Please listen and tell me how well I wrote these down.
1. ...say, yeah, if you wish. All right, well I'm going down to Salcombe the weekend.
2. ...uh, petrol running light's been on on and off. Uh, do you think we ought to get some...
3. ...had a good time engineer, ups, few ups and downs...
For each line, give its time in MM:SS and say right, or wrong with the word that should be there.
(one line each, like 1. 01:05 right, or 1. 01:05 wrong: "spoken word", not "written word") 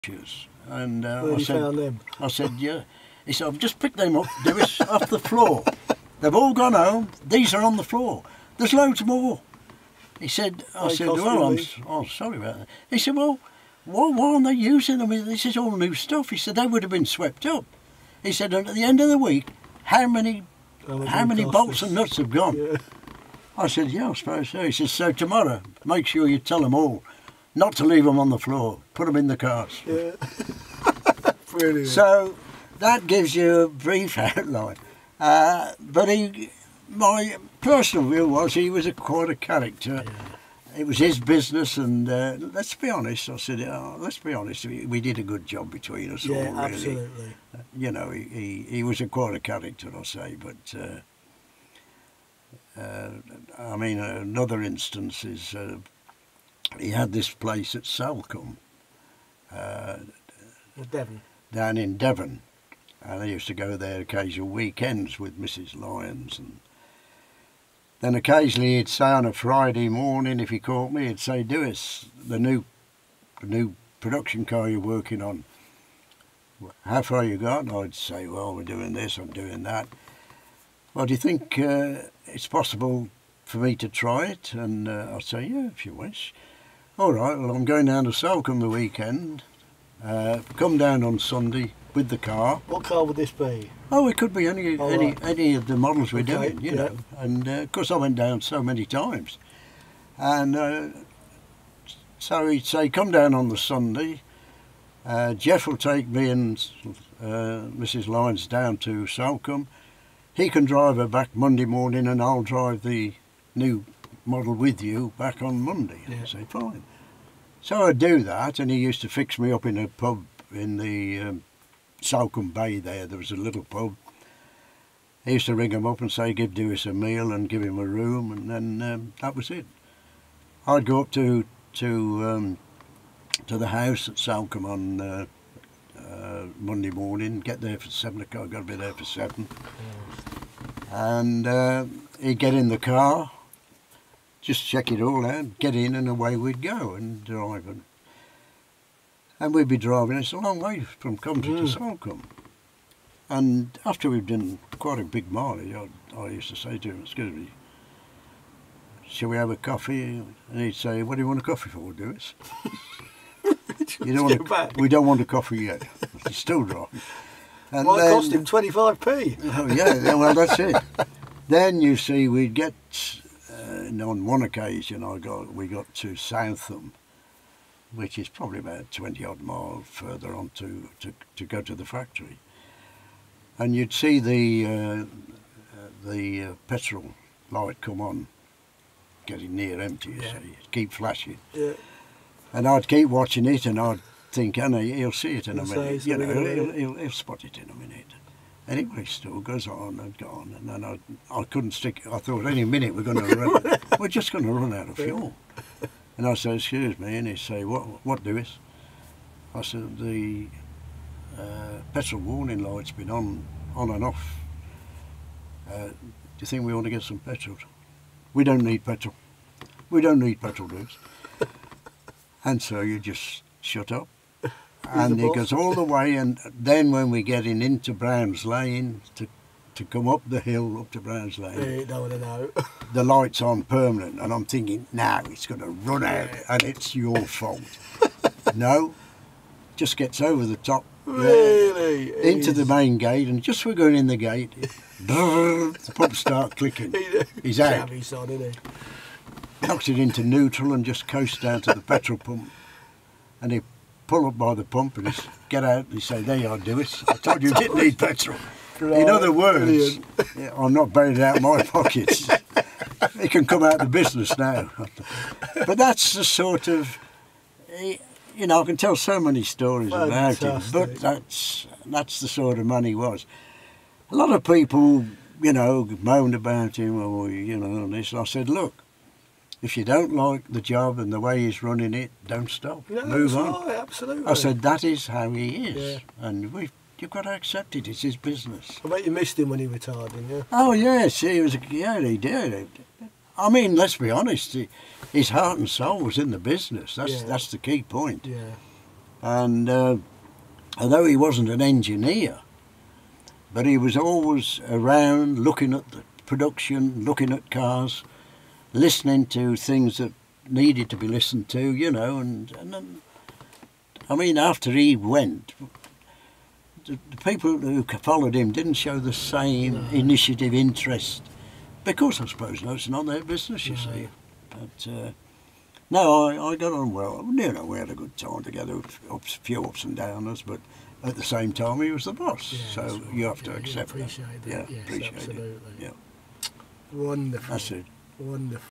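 1. 01:25 right
2. 03:31 wrong: "warning", not "running"
3. 05:27 wrong: "together", not "engineer".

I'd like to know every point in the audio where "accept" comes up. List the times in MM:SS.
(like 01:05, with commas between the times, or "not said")
04:47, 05:33.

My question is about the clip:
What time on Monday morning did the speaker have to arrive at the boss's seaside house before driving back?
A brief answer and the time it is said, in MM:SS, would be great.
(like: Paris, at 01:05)
7 o'clock, at 02:17.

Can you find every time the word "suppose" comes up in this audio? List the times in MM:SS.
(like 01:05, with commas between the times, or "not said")
00:24, 05:22.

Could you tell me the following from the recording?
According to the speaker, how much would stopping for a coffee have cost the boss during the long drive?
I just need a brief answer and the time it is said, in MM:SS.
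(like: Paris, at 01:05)
25p, at 02:48.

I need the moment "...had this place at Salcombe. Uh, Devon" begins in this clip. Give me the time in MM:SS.
00:56.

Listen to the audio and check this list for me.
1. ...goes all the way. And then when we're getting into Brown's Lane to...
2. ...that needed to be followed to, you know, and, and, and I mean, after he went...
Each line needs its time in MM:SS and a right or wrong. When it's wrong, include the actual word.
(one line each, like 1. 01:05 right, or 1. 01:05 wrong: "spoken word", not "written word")
1. 03:45 right
2. 05:09 wrong: "listened", not "followed".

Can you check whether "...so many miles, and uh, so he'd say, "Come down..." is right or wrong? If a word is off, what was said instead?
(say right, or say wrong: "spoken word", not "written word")
wrong: "times", not "miles".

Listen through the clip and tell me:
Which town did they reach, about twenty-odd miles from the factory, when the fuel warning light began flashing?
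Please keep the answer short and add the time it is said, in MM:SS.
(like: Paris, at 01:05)
Southam, at 02:56.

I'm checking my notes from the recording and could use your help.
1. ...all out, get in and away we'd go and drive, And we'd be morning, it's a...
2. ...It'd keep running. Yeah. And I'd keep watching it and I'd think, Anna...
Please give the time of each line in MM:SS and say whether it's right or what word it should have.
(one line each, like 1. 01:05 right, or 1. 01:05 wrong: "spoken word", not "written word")
1. 02:25 wrong: "driving", not "morning"
2. 03:10 wrong: "flashing", not "running".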